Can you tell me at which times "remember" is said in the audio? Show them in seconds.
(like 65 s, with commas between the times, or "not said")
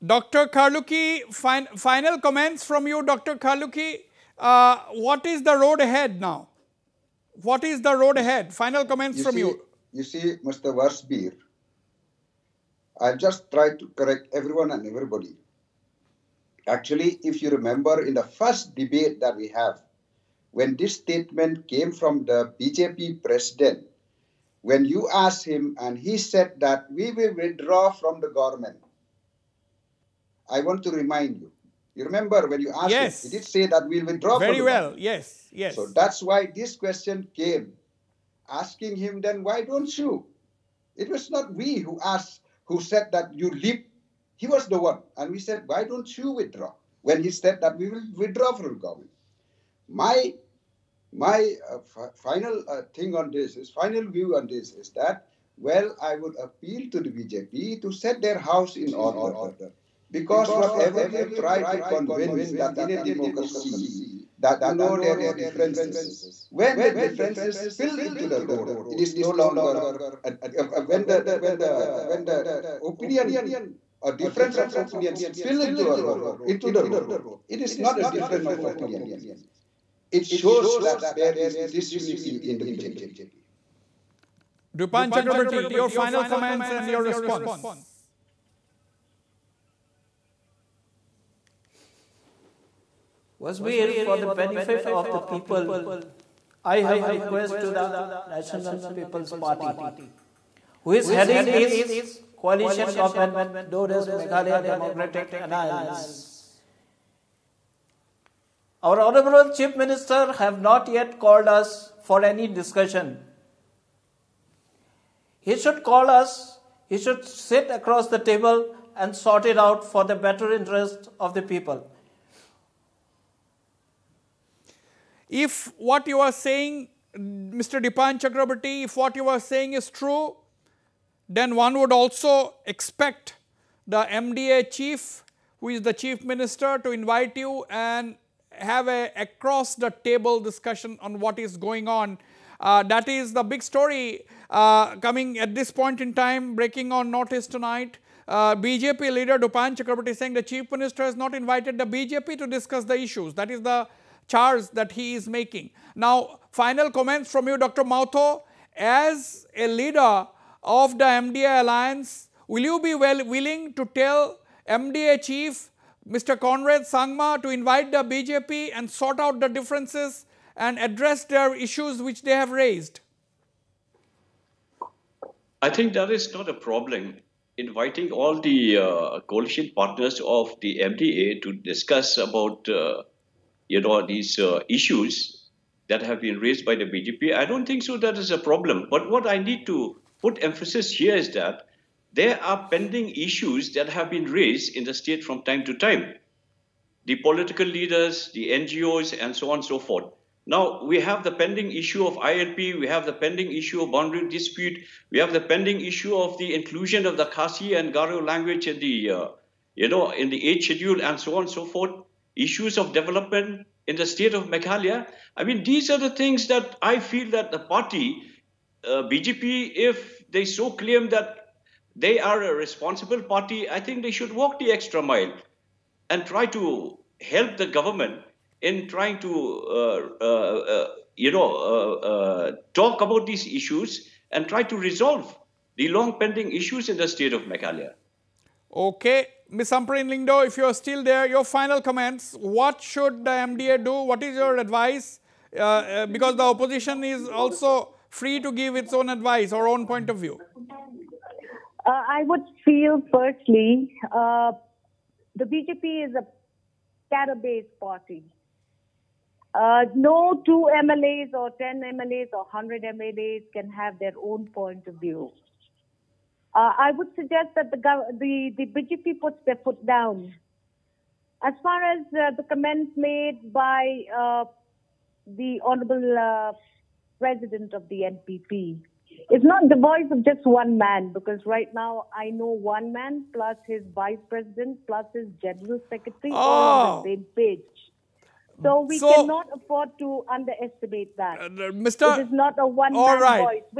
17 s, 32 s.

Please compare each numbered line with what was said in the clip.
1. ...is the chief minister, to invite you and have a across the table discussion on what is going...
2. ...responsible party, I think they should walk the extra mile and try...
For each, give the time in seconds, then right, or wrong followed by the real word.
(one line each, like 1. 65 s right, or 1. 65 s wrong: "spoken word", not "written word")
1. 135 s right
2. 222 s right.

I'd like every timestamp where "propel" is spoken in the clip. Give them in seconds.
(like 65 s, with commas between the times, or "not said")
not said.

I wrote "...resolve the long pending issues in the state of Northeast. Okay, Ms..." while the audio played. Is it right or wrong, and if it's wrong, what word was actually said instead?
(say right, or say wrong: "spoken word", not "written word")
wrong: "Meghalaya", not "Northeast".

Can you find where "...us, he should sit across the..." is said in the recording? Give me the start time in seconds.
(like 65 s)
116 s.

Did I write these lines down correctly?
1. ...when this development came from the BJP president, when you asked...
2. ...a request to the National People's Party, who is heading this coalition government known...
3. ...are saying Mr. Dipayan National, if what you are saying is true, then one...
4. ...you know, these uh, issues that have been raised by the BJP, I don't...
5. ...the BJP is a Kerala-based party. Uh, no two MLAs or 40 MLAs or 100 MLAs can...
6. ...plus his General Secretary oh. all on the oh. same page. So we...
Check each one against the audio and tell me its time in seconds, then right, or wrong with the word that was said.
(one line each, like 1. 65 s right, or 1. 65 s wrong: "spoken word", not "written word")
1. 20 s wrong: "statement", not "development"
2. 97 s right
3. 126 s wrong: "Chakrabarti", not "National"
4. 183 s right
5. 255 s wrong: "10", not "40"
6. 284 s right.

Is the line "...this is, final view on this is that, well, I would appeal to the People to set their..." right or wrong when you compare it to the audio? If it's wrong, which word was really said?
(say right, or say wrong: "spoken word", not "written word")
wrong: "BJP", not "People".